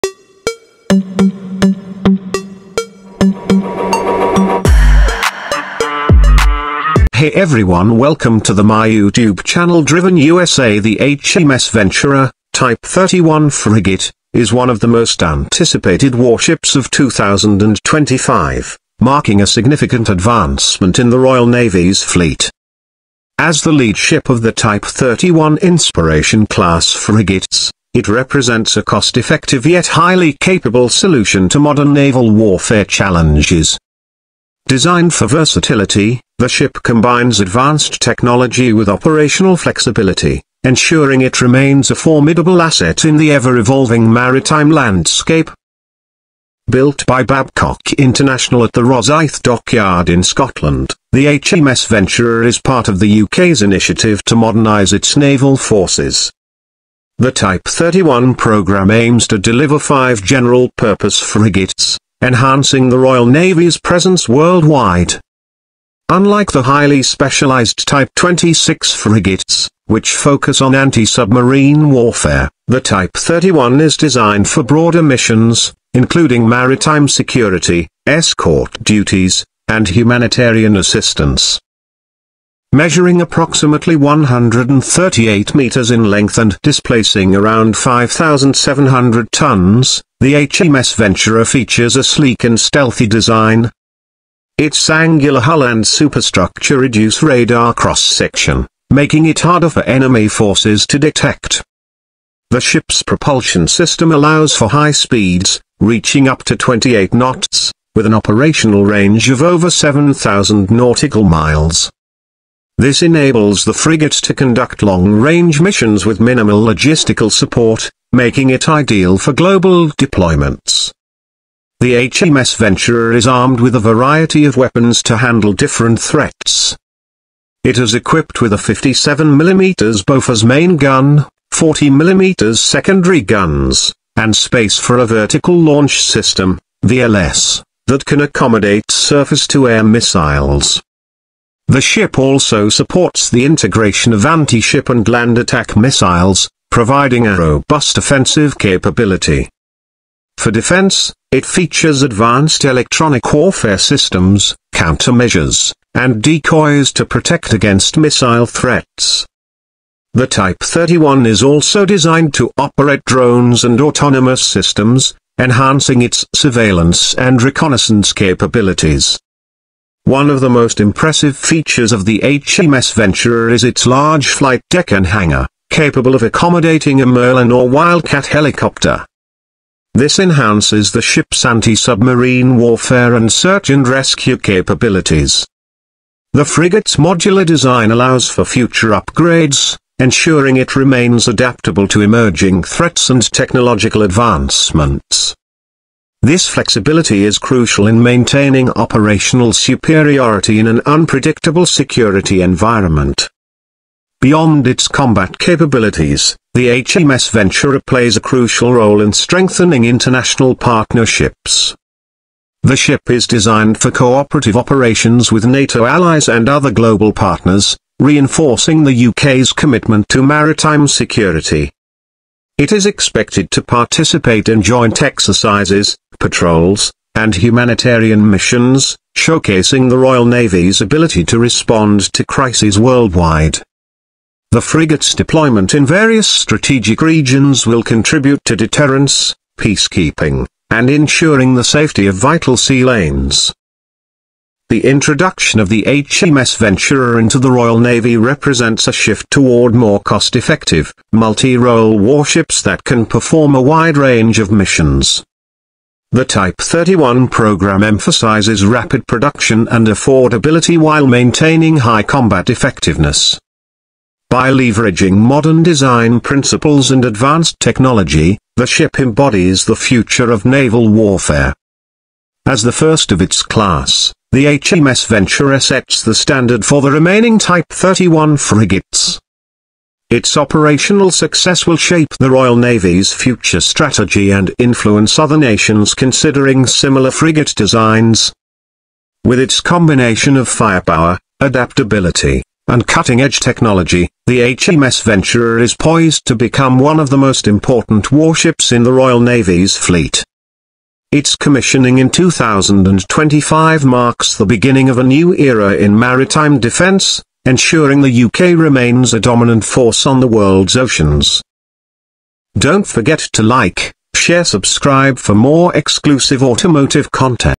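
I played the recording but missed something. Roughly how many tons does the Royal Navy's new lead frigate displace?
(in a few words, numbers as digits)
5,700 tons.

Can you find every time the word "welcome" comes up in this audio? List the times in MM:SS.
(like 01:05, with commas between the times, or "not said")
00:07.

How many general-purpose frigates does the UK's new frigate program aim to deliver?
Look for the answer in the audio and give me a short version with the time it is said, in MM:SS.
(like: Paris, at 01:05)
5, at 00:59.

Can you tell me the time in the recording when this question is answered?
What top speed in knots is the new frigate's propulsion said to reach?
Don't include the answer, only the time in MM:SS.
01:46.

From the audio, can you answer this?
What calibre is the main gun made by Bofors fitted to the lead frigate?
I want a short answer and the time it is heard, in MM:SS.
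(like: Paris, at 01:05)
57mm, at 02:08.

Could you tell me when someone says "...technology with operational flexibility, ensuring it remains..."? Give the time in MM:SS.
00:38.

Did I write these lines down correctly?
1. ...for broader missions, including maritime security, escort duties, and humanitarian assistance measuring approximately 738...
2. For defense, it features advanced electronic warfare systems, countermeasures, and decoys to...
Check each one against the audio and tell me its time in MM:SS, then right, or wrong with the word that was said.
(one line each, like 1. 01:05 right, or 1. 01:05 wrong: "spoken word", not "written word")
1. 01:14 wrong: "138", not "738"
2. 02:30 right.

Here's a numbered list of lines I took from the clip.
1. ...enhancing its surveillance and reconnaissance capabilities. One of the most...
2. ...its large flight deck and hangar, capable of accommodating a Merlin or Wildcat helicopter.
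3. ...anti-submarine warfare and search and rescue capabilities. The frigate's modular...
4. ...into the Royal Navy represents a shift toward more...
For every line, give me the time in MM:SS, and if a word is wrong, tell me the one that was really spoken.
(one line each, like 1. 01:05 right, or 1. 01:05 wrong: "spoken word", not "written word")
1. 02:45 right
2. 02:53 right
3. 03:01 right
4. 04:07 right.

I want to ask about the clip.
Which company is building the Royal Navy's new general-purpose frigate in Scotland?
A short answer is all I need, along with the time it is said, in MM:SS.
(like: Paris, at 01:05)
Babcock International, at 00:47.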